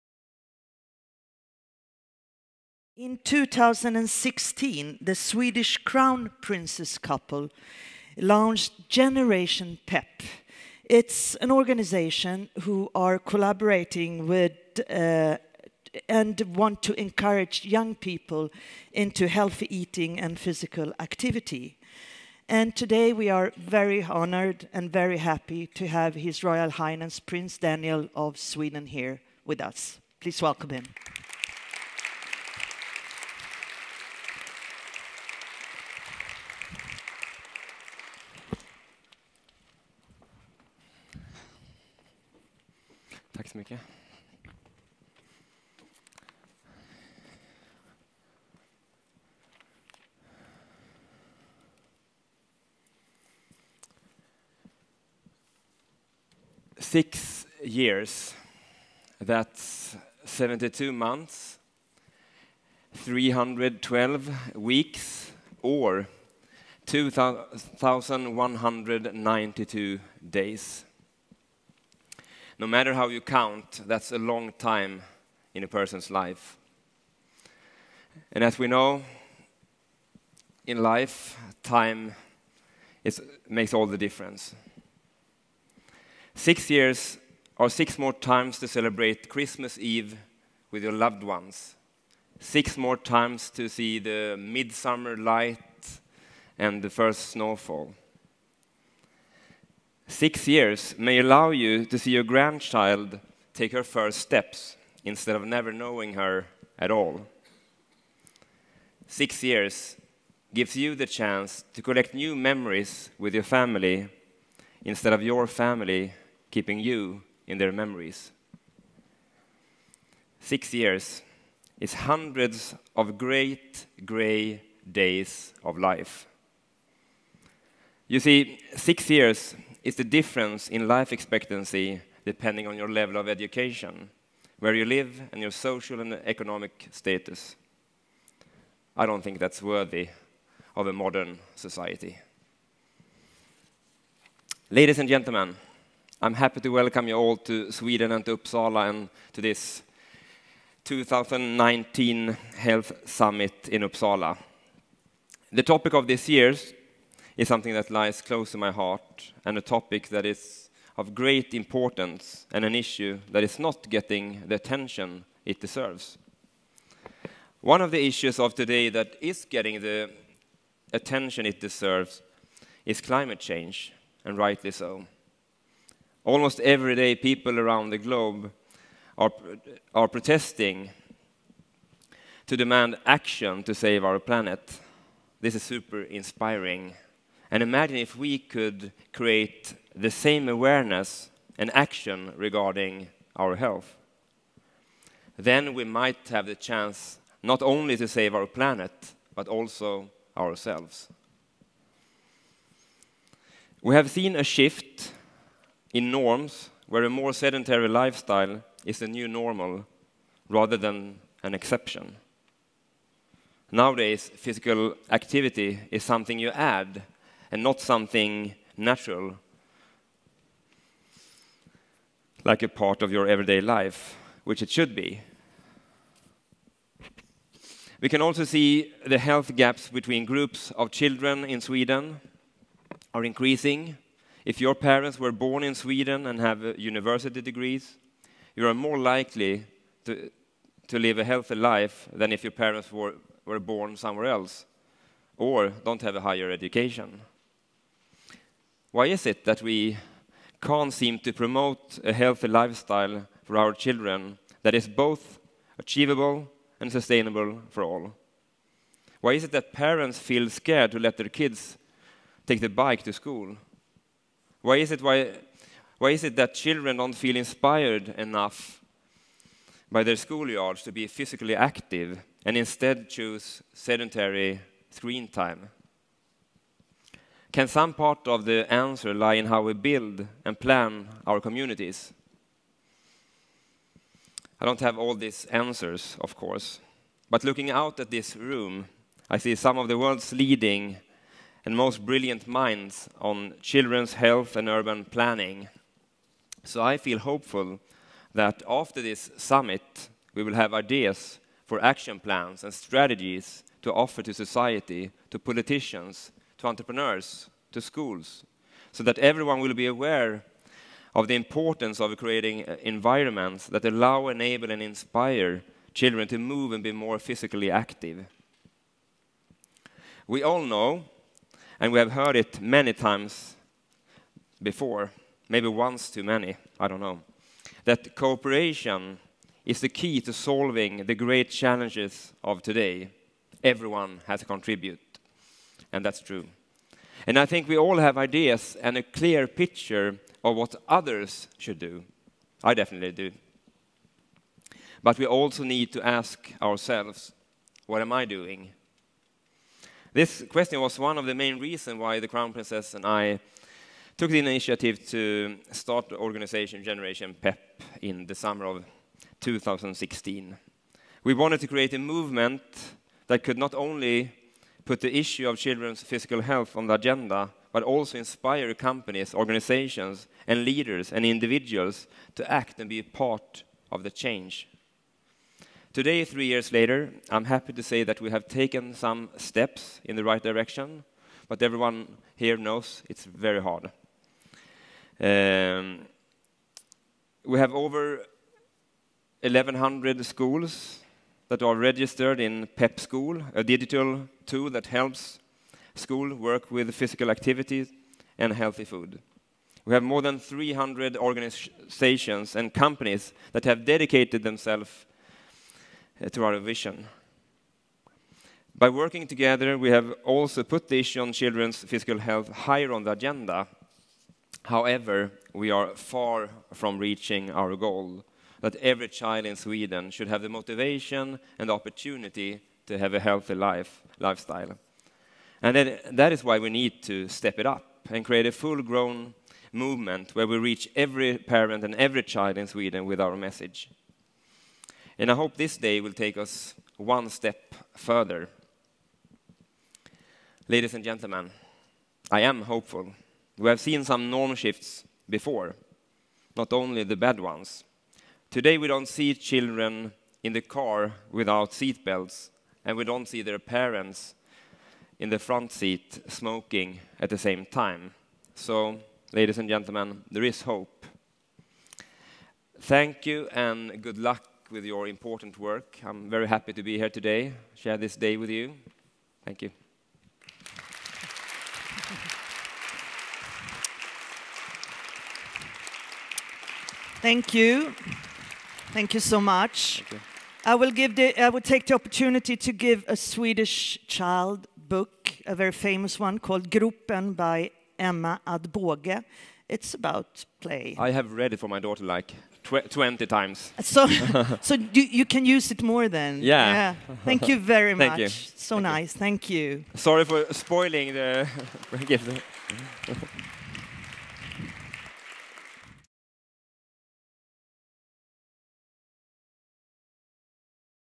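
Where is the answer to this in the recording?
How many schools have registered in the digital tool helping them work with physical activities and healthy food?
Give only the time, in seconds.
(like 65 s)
389 s.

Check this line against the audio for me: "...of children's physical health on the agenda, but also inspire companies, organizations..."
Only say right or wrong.
right.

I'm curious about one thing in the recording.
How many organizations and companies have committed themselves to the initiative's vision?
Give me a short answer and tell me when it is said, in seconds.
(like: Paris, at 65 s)
300, at 400 s.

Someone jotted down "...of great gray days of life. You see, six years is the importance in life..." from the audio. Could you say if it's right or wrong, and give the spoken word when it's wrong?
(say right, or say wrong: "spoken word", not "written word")
wrong: "difference", not "importance".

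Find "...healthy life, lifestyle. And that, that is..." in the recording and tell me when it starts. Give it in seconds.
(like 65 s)
423 s.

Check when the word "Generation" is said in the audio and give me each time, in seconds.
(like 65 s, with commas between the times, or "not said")
8 s, 356 s.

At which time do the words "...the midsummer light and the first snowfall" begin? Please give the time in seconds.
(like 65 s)
93 s.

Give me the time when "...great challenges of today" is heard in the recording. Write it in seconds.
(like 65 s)
331 s.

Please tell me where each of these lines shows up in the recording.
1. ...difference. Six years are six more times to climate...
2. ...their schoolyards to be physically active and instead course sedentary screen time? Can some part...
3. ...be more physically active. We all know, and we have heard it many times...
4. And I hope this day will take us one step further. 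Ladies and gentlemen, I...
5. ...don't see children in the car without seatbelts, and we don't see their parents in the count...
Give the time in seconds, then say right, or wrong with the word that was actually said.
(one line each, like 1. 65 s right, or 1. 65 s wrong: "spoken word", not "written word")
1. 83 s wrong: "celebrate", not "climate"
2. 270 s wrong: "choose", not "course"
3. 316 s right
4. 435 s right
5. 448 s wrong: "front", not "count".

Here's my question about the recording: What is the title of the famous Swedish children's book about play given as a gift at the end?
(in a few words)
Gropen.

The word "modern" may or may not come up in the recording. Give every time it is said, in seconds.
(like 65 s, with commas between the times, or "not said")
140 s.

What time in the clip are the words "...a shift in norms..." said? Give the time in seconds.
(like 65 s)
204 s.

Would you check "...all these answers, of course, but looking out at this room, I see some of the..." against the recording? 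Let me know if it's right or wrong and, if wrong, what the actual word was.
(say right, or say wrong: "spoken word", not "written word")
right.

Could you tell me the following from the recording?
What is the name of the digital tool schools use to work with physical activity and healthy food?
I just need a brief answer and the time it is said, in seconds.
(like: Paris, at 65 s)
PEP School, at 392 s.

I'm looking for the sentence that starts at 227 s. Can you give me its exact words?
We can also see the health gaps between groups of children in Sweden are increasing.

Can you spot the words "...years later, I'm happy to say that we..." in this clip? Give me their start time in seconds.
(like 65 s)
376 s.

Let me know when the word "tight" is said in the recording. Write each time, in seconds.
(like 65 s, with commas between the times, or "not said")
not said.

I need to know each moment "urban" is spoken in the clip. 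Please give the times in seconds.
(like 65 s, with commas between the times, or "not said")
294 s.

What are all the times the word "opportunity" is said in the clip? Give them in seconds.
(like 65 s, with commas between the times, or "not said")
421 s, 481 s.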